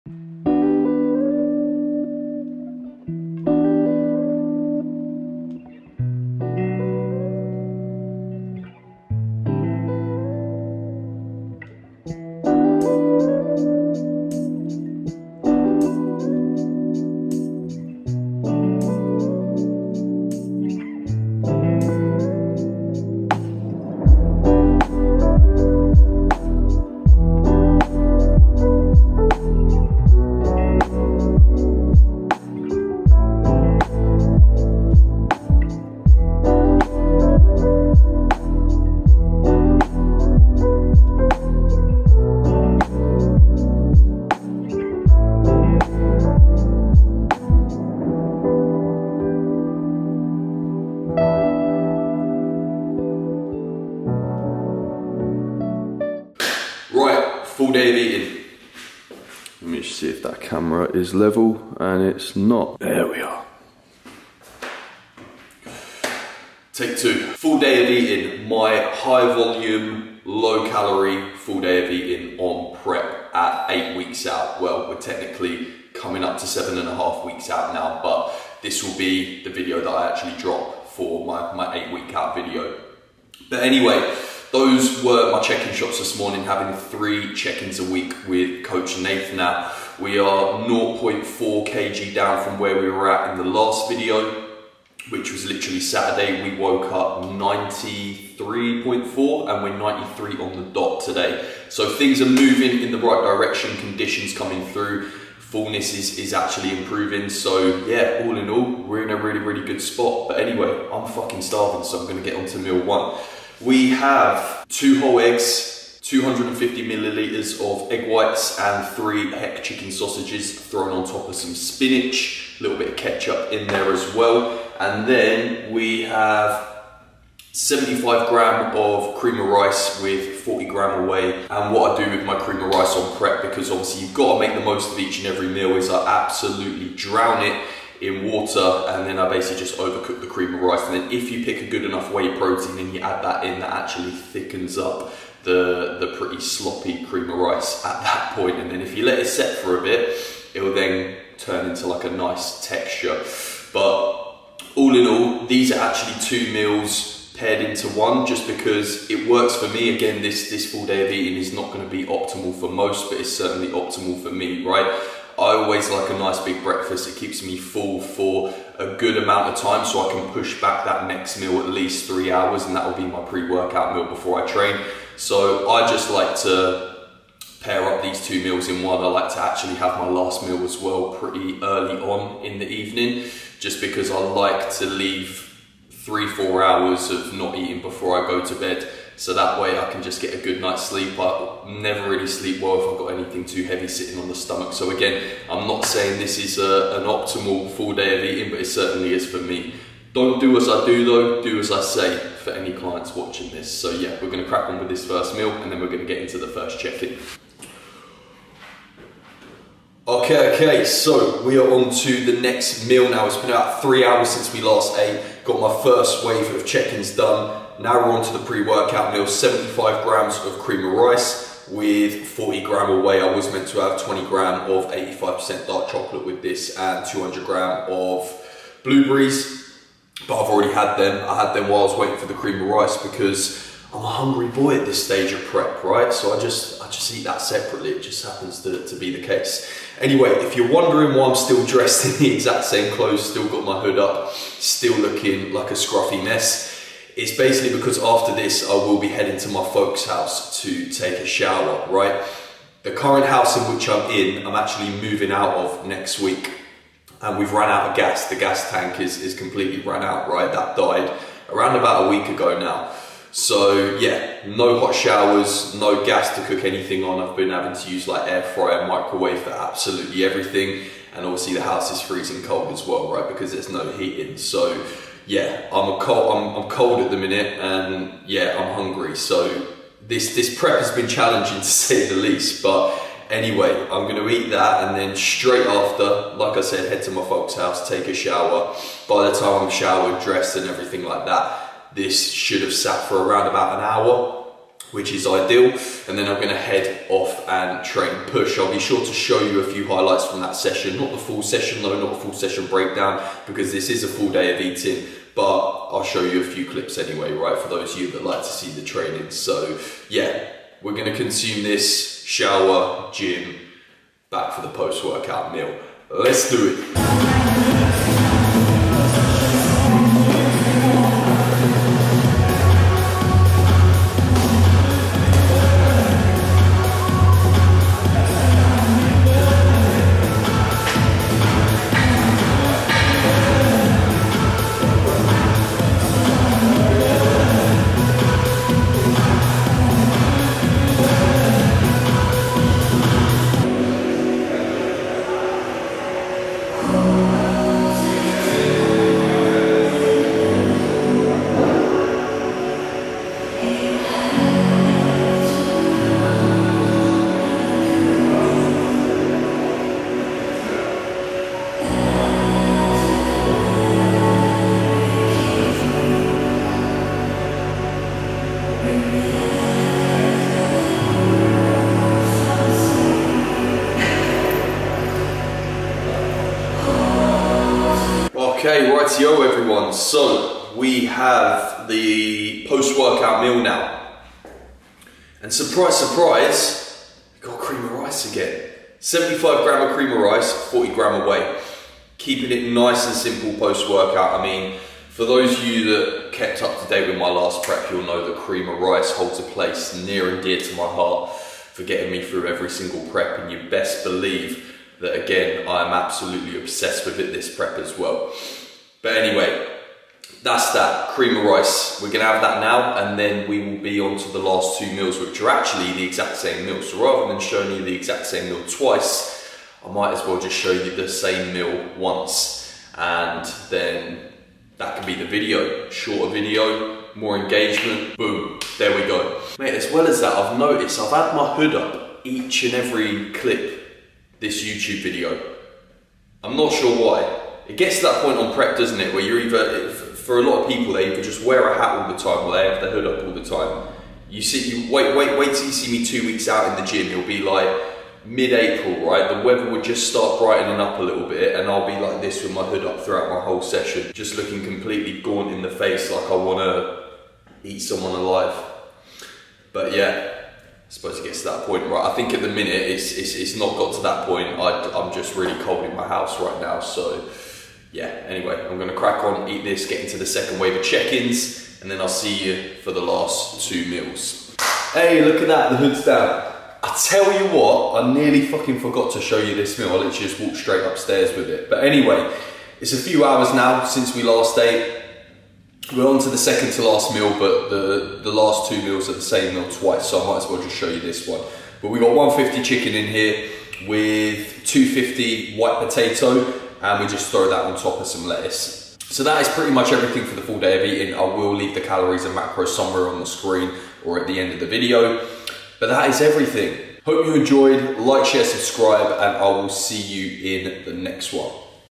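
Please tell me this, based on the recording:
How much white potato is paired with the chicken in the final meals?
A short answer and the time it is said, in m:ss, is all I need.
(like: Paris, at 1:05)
250 grams, at 8:14.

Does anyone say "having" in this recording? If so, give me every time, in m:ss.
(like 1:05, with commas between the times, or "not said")
1:26, 4:27.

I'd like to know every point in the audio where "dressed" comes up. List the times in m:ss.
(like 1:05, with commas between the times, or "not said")
4:01, 4:50.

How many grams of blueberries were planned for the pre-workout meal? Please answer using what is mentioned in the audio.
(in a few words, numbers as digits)
200 grams.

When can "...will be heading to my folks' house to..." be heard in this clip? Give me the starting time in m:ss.
4:08.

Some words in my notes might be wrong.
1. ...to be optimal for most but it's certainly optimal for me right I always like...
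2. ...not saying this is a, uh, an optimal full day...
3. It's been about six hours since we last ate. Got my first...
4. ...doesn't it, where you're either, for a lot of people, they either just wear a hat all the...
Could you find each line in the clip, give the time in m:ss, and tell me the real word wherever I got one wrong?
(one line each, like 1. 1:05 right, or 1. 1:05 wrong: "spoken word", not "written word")
1. 2:41 right
2. 3:15 right
3. 3:33 wrong: "three", not "six"
4. 7:18 right.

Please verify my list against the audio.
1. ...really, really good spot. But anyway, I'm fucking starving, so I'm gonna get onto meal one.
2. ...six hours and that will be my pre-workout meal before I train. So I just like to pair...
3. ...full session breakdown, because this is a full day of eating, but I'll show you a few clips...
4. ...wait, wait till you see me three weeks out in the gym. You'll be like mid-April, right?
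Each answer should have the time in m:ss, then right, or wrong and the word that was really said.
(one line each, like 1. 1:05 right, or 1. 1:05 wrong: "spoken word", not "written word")
1. 1:49 right
2. 2:52 wrong: "three", not "six"
3. 5:02 right
4. 7:25 wrong: "two", not "three".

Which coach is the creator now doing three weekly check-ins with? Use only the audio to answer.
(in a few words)
Nathan.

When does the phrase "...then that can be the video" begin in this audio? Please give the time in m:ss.
7:03.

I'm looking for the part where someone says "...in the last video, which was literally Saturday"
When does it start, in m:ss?
1:33.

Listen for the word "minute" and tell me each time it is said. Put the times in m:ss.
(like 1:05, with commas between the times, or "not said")
4:37, 7:42.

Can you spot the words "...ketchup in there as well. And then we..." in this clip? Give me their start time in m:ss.
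2:02.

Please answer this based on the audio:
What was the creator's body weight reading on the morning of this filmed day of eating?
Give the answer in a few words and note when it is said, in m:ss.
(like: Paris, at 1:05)
93, at 1:39.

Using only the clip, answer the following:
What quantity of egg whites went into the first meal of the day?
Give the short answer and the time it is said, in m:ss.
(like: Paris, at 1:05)
250 milliliters, at 1:56.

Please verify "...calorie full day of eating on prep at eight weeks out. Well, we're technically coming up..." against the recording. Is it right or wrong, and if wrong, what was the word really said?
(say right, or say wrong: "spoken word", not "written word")
right.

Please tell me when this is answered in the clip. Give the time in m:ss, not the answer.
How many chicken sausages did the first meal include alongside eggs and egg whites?
1:58.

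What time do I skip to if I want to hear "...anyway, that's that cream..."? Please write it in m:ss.
6:49.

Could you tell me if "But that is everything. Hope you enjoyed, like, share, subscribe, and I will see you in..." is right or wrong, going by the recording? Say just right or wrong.
right.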